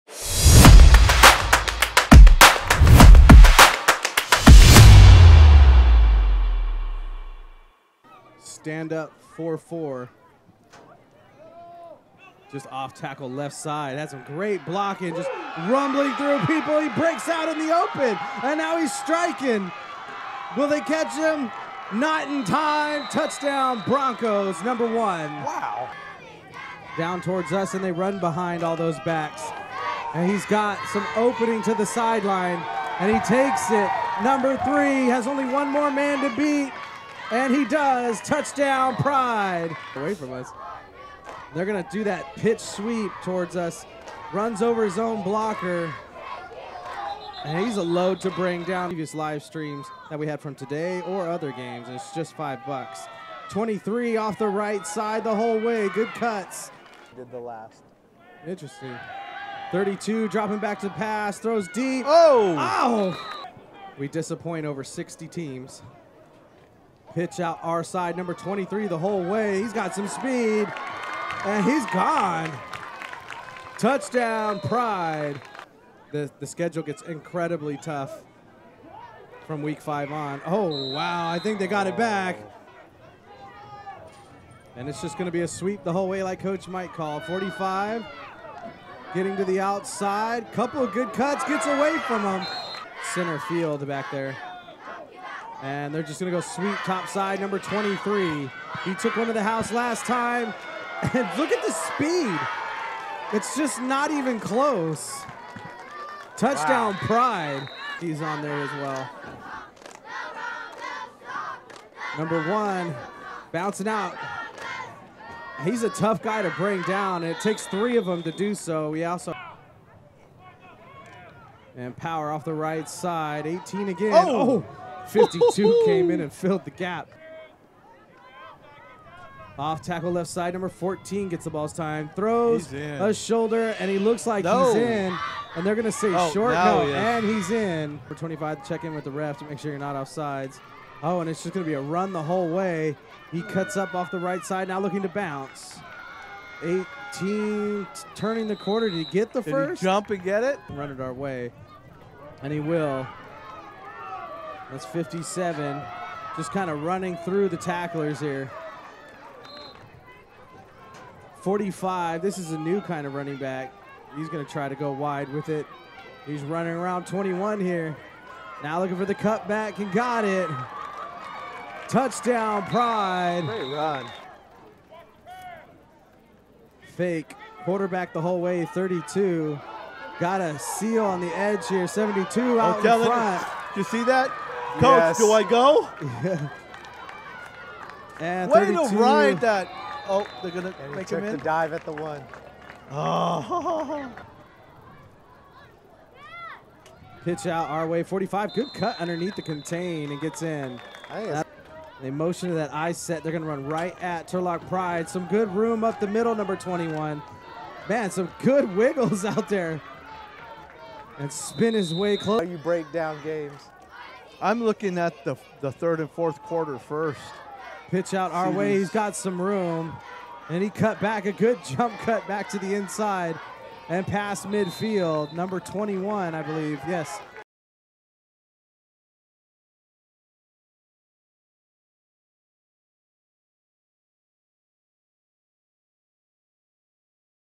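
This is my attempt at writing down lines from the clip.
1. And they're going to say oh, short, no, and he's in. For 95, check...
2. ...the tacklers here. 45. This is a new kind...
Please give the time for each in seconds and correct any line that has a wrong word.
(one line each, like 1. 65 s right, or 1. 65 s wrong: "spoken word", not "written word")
1. 135 s wrong: "25", not "95"
2. 157 s right.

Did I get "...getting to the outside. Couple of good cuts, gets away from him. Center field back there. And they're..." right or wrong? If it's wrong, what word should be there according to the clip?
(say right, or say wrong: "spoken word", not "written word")
right.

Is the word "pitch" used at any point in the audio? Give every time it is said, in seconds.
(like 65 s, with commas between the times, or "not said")
42 s, 67 s, 197 s, 217 s.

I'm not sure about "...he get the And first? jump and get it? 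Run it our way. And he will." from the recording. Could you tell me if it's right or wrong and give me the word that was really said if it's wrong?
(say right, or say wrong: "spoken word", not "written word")
wrong: "Did", not "And".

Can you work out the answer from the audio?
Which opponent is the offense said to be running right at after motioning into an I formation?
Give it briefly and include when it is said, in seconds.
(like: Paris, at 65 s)
Turlock Pride, at 204 s.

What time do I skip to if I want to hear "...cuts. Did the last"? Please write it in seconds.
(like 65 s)
56 s.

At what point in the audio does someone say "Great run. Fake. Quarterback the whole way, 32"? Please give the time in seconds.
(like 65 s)
173 s.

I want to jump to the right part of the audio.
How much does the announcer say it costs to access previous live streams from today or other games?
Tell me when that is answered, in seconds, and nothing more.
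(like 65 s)
52 s.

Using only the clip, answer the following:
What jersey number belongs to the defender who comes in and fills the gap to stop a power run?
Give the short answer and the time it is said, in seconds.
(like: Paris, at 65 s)
52, at 125 s.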